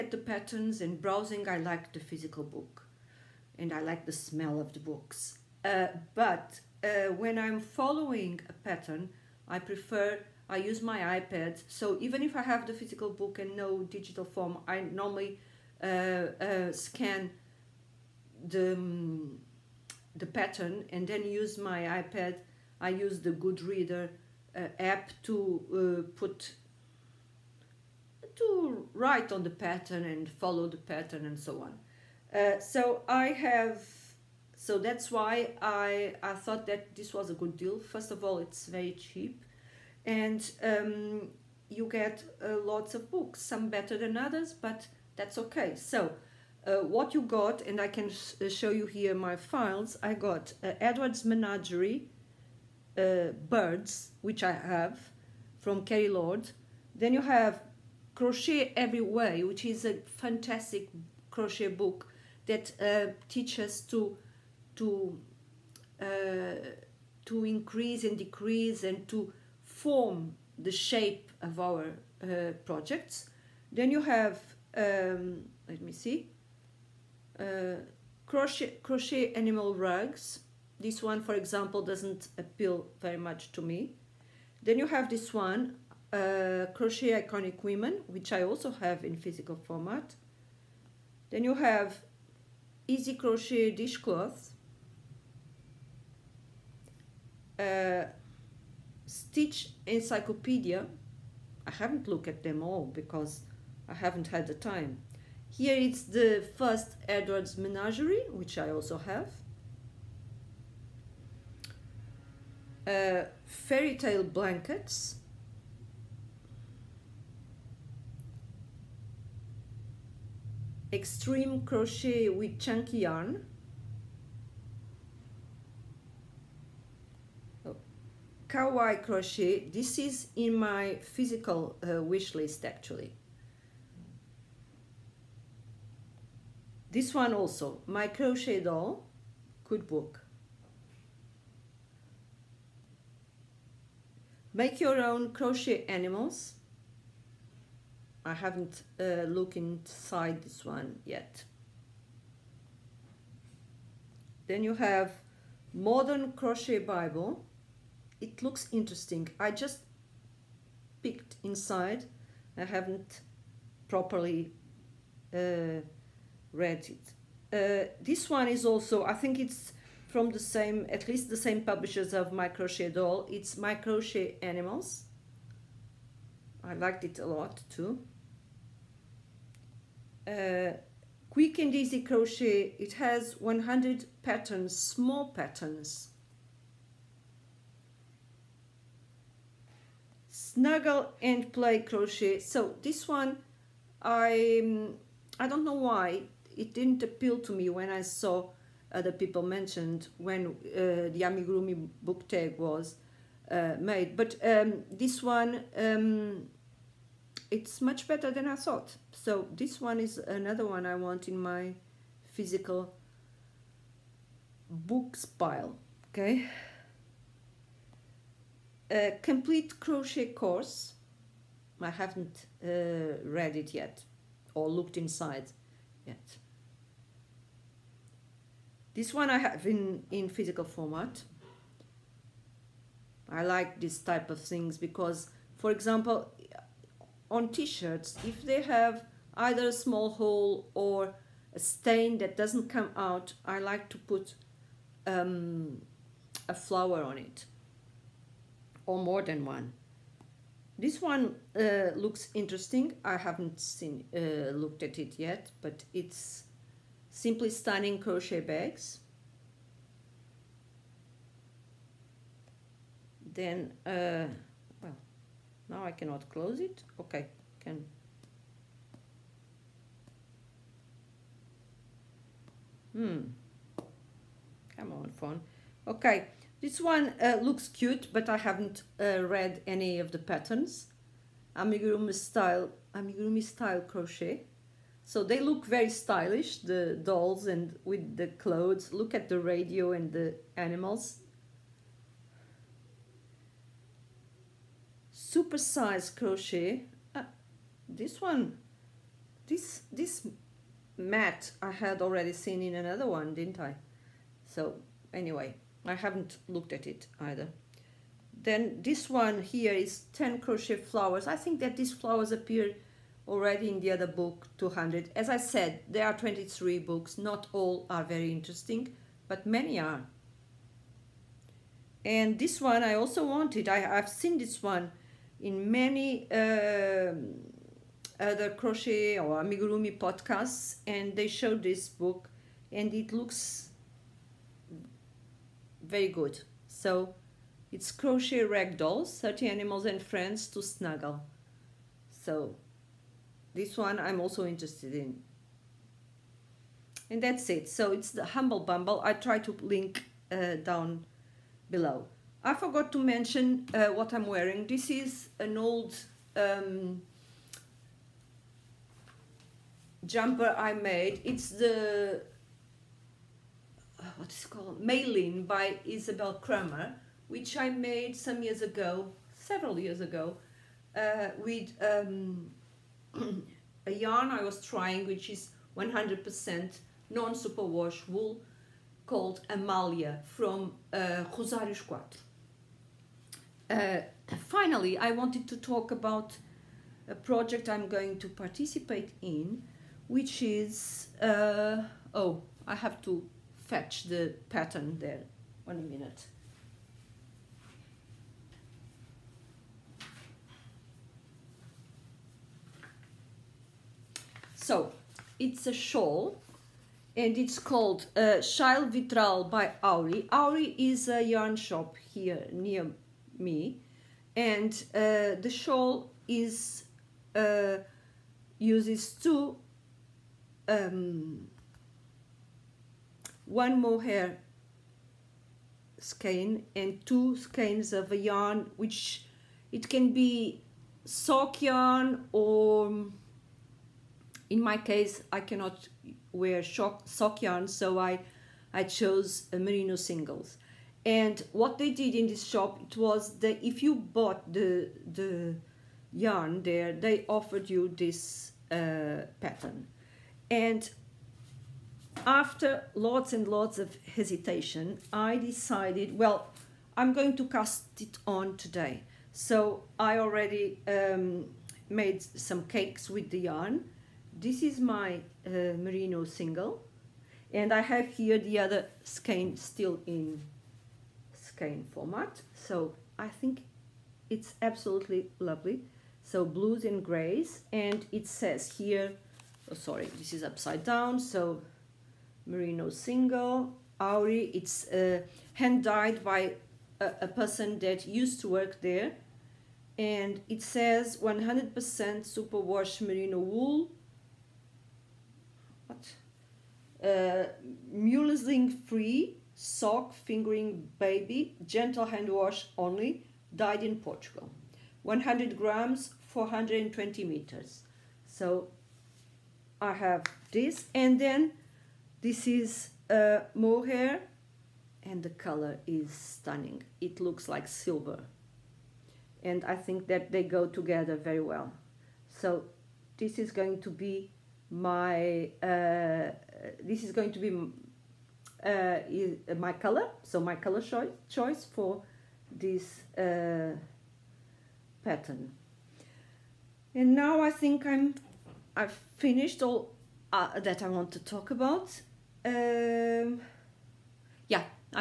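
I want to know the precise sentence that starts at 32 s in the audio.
Uh, so I have so that's why I, I thought that this was a good deal.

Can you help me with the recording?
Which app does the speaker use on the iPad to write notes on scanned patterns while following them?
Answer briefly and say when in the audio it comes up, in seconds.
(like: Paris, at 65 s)
GoodReader, at 23 s.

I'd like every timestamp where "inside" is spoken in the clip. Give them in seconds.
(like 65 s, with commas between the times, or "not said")
149 s, 161 s, 224 s.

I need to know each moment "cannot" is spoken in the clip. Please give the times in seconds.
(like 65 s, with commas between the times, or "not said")
265 s, 435 s.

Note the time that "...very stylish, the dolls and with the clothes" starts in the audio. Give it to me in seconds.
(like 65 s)
285 s.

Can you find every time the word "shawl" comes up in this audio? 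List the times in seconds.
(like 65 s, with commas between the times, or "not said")
405 s, 415 s.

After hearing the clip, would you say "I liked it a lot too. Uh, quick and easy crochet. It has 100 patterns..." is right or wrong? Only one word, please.
right.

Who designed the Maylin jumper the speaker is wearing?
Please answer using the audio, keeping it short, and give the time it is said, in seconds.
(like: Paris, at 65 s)
Isabell Kraemer, at 365 s.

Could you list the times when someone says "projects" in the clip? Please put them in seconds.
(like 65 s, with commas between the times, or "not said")
72 s, 387 s.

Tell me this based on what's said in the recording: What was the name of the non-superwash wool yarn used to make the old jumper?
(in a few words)
Amalia.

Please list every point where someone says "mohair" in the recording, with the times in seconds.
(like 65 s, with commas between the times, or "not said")
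423 s, 513 s.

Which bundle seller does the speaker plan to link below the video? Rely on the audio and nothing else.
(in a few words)
Humble Bumble.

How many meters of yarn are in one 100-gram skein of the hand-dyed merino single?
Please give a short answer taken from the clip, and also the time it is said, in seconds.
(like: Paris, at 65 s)
420, at 506 s.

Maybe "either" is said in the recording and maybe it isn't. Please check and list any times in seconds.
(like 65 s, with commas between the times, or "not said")
239 s, 307 s.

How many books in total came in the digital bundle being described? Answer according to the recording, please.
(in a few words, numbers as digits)
23.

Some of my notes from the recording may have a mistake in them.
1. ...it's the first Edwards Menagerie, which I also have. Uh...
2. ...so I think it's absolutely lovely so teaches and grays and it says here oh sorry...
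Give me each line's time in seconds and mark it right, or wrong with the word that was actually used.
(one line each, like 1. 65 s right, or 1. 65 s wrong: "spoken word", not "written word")
1. 105 s right
2. 472 s wrong: "blues", not "teaches".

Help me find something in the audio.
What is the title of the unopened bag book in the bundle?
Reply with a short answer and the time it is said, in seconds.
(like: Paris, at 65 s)
Simply Stunning Crochet Bags, at 257 s.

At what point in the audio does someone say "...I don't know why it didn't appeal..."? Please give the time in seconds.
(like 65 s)
195 s.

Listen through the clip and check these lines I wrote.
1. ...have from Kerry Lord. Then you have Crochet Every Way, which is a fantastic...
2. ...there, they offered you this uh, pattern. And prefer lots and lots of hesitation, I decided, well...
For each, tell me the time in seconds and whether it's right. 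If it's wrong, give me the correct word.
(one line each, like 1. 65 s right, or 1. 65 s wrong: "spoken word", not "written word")
1. 54 s right
2. 446 s wrong: "after", not "prefer".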